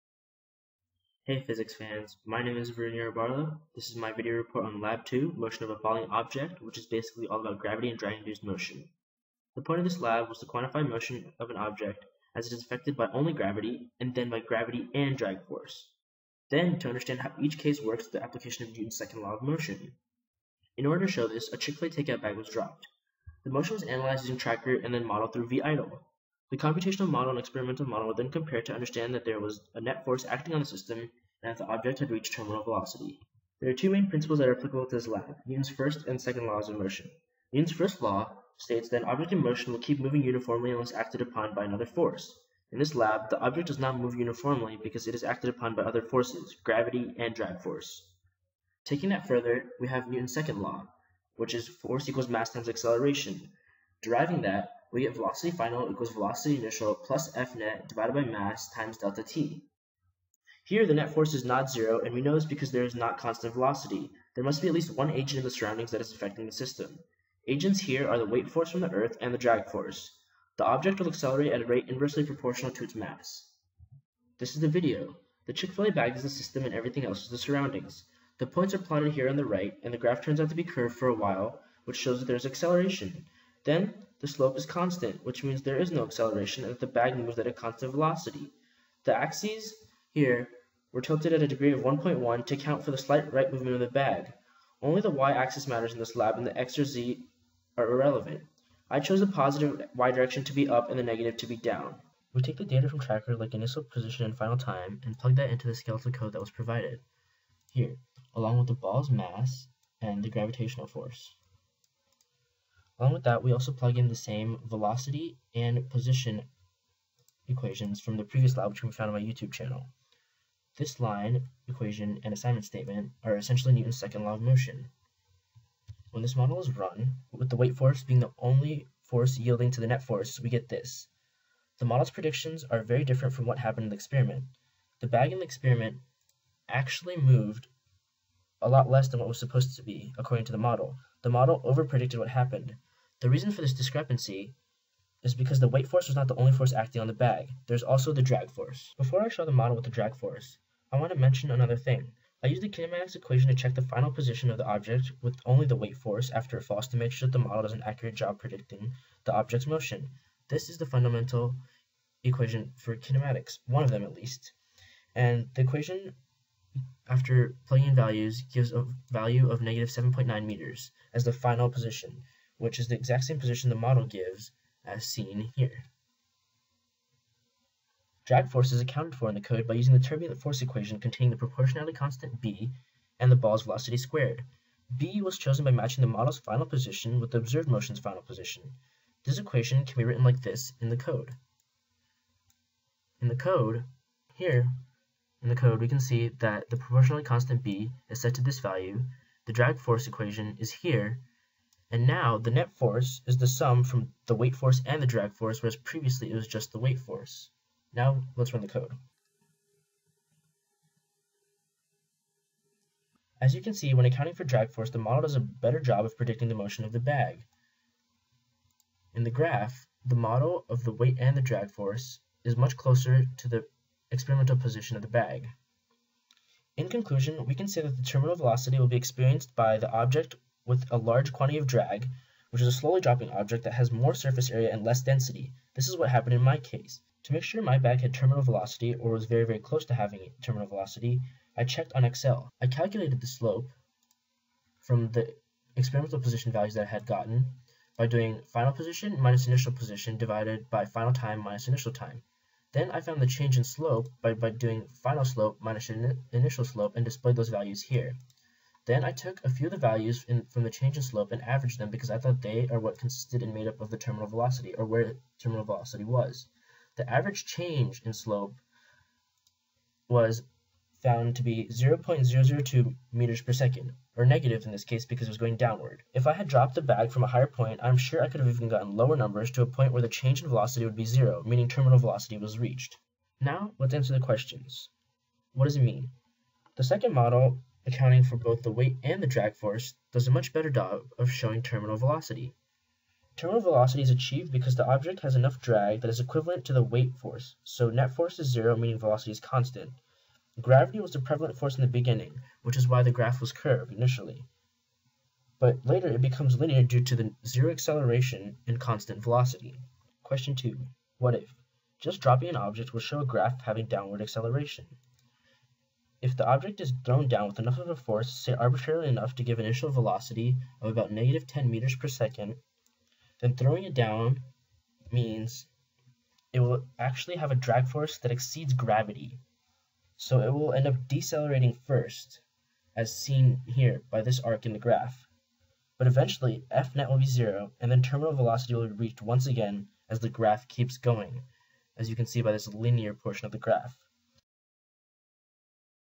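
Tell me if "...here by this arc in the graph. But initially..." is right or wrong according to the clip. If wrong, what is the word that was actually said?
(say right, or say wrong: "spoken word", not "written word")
wrong: "eventually", not "initially".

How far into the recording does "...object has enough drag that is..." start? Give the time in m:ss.
4:54.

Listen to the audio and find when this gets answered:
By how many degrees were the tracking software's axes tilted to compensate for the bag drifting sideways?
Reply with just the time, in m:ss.
1:31.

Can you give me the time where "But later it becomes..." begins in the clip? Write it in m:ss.
5:05.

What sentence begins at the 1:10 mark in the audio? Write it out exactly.
The object will accelerate at a rate inversely proportional to its mass.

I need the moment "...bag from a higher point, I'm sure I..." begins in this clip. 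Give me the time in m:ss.
4:36.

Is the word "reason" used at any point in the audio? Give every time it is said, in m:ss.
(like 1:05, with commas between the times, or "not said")
2:23.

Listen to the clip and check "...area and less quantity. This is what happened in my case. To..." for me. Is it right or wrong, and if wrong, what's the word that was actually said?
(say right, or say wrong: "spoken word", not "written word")
wrong: "density", not "quantity".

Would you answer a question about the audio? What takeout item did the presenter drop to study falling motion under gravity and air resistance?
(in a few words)
Chick-fil-A takeout bag.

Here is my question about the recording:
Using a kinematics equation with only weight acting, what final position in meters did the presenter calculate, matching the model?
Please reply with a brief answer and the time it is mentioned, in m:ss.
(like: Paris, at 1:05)
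-7.9 meters, at 2:49.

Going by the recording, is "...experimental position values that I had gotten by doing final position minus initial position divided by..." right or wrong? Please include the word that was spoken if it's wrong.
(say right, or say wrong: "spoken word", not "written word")
right.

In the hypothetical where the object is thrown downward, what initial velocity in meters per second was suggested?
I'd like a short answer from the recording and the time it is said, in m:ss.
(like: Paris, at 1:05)
-10 m/s, at 5:21.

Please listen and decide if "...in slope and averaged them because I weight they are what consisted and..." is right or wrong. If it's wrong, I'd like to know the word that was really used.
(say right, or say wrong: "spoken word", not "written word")
wrong: "thought", not "weight".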